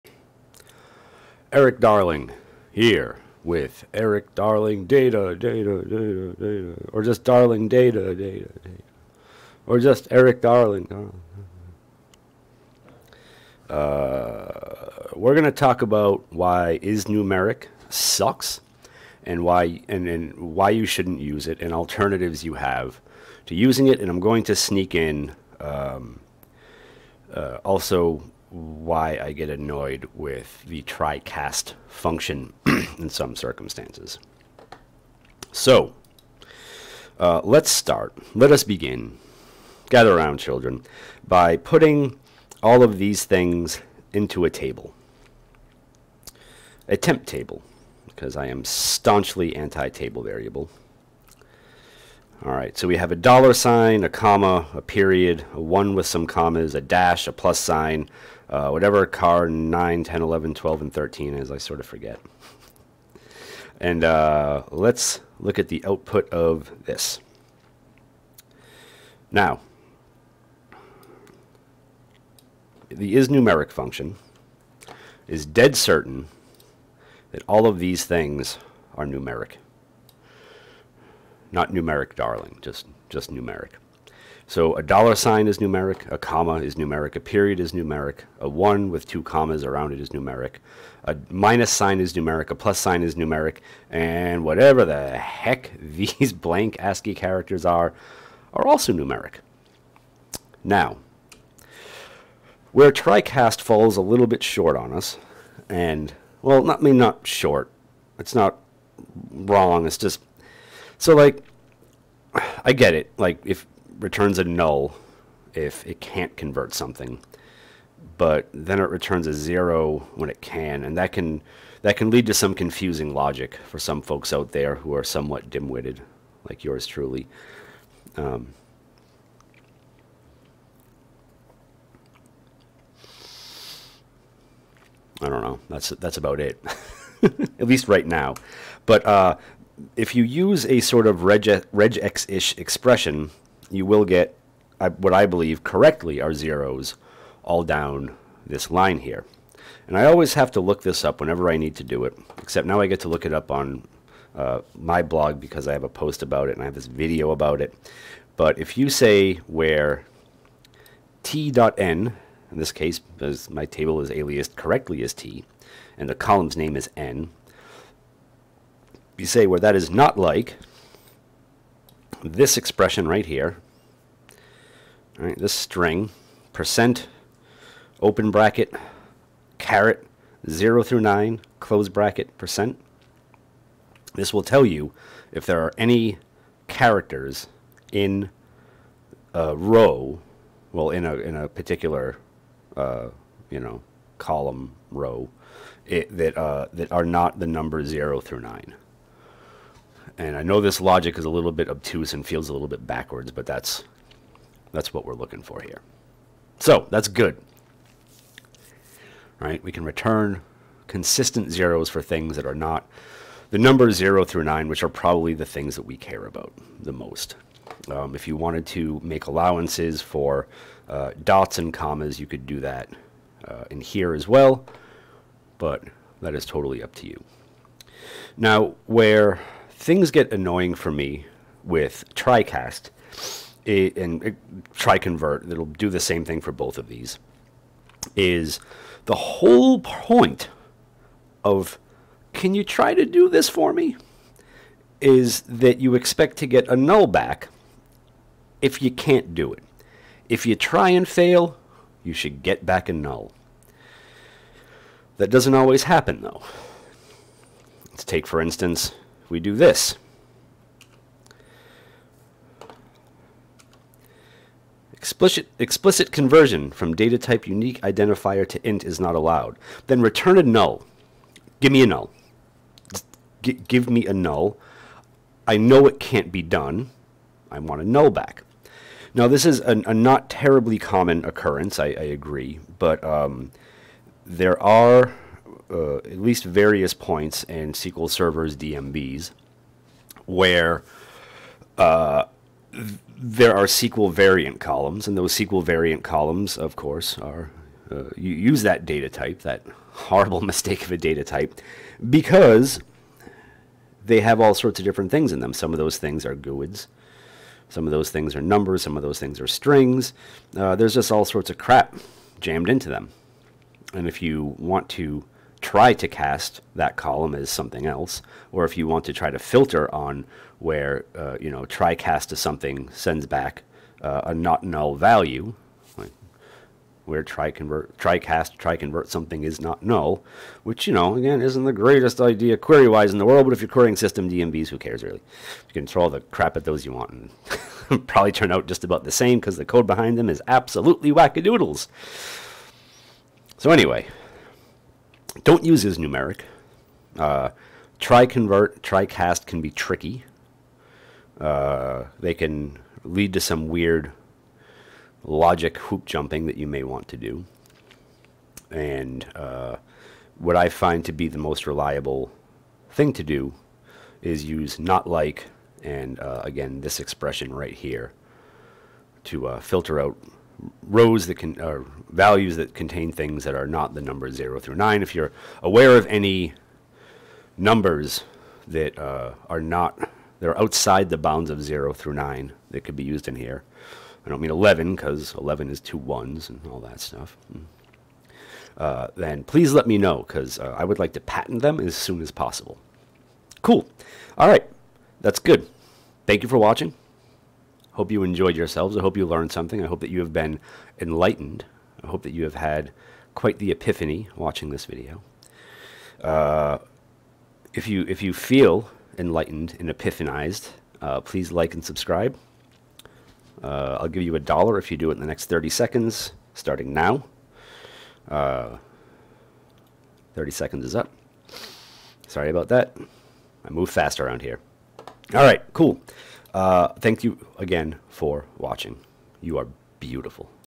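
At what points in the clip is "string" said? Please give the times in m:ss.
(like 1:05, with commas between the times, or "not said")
2:55, 5:09.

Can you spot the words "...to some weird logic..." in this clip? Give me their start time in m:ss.
5:53.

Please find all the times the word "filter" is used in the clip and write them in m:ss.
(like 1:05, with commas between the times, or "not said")
5:19, 6:09.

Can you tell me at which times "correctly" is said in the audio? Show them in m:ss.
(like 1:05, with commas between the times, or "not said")
2:25, 2:44.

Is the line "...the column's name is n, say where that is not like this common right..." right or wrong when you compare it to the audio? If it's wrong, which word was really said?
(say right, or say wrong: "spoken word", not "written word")
wrong: "expression", not "common".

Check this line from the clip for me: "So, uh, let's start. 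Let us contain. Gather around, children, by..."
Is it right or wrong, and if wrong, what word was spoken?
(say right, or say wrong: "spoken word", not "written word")
wrong: "begin", not "contain".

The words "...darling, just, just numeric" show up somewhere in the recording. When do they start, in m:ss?
1:22.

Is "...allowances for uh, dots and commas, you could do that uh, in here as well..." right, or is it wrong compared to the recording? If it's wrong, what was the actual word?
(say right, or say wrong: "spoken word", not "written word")
right.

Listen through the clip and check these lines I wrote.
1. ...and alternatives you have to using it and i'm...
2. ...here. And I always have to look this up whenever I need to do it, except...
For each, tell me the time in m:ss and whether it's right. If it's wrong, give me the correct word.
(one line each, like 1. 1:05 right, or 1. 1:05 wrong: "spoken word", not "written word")
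1. 0:21 right
2. 2:28 right.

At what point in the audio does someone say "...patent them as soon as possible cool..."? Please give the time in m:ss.
6:31.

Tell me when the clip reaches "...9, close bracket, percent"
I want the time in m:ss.
3:01.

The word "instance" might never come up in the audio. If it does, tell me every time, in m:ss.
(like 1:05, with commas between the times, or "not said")
4:18.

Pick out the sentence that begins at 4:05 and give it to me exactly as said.
Is that you expect to get a null back if you can't do it.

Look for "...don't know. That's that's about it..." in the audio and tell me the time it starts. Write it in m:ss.
2:15.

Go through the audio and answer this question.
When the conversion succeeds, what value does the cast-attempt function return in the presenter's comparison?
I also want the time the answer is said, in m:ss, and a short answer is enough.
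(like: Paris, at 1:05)
0, at 1:59.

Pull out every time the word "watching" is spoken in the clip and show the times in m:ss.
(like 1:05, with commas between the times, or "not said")
6:36, 6:44, 7:08.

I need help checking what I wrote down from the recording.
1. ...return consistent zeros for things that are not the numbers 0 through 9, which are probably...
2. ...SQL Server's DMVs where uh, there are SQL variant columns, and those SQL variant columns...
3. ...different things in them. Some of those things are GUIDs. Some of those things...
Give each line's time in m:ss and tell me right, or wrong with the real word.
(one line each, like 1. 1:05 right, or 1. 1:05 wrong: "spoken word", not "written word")
1. 3:29 right
2. 4:47 right
3. 5:04 right.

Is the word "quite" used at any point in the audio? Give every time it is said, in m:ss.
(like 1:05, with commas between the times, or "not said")
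6:43.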